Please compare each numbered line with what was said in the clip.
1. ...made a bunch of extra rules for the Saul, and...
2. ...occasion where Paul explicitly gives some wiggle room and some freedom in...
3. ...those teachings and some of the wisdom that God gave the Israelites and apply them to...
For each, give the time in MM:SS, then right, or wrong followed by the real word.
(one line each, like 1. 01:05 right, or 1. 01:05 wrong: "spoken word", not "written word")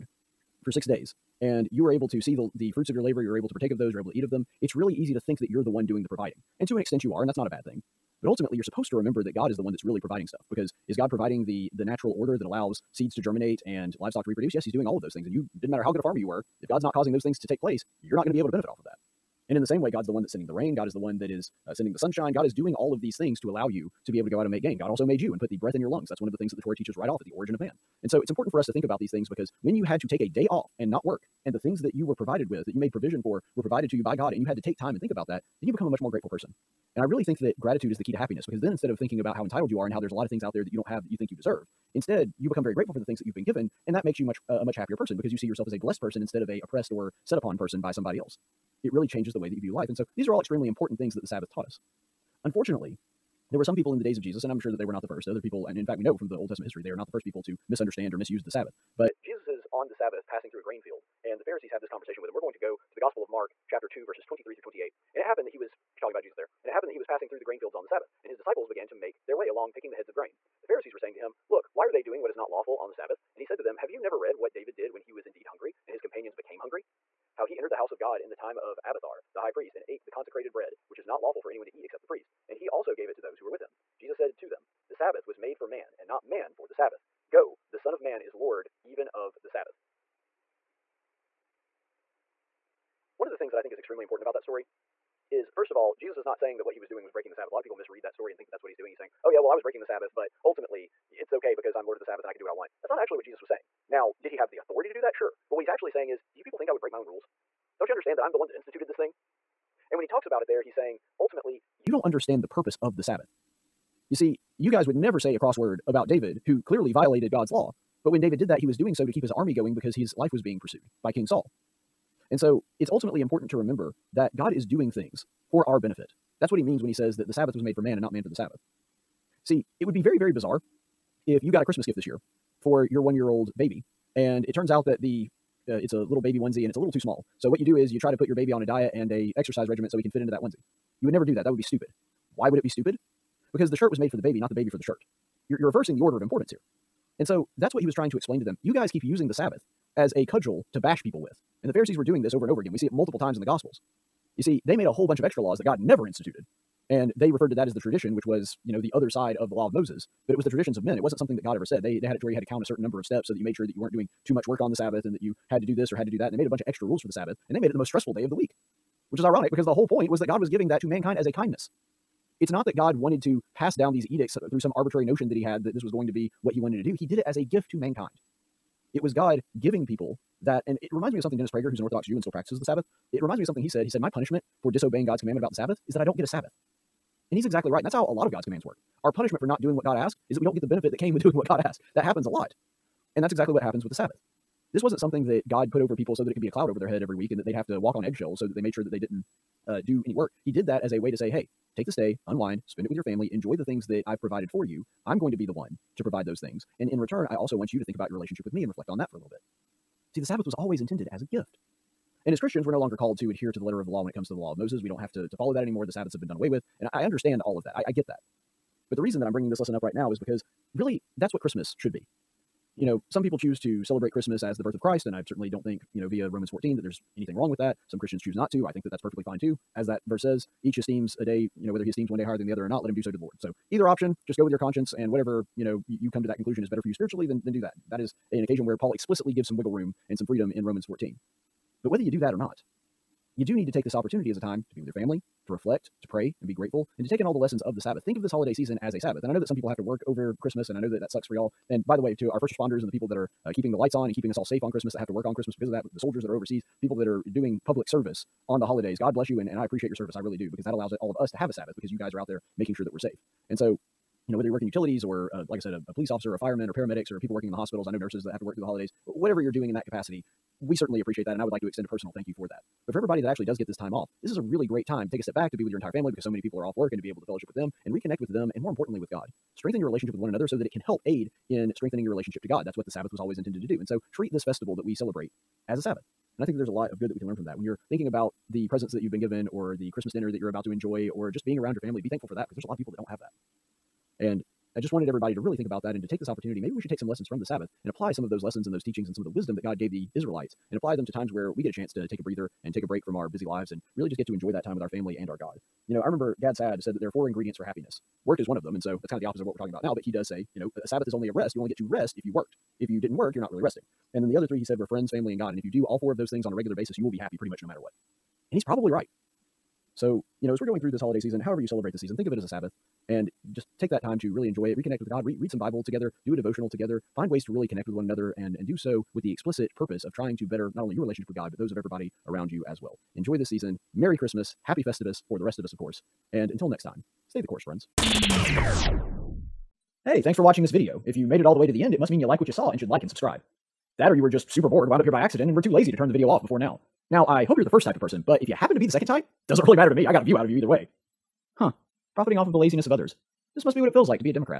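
1. 02:46 wrong: "Sabbath", not "Saul"
2. 03:58 right
3. 04:58 right.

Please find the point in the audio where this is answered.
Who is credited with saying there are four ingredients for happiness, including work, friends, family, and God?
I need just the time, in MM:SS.
05:06.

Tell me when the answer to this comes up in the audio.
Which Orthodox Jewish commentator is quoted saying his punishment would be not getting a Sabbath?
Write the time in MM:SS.
03:01.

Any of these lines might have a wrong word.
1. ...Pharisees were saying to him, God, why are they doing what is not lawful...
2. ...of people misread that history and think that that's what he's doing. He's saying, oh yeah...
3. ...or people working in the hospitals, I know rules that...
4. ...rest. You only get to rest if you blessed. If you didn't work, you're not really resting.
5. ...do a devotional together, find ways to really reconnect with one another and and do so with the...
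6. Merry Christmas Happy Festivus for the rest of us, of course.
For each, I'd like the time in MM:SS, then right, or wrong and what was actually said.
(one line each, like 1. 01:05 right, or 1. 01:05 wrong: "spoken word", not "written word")
1. 01:10 wrong: "Look", not "God"
2. 01:37 wrong: "story", not "history"
3. 04:27 wrong: "nurses", not "rules"
4. 05:11 wrong: "worked", not "blessed"
5. 05:26 wrong: "connect", not "reconnect"
6. 05:33 right.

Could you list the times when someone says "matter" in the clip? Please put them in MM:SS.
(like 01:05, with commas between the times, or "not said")
00:15, 05:17, 05:49.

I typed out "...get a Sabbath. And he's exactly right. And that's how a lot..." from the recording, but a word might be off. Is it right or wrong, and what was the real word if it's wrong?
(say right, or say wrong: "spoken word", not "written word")
right.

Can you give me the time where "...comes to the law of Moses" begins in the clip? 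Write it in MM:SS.
03:34.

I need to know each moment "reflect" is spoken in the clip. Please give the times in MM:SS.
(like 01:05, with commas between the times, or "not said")
03:28, 04:05.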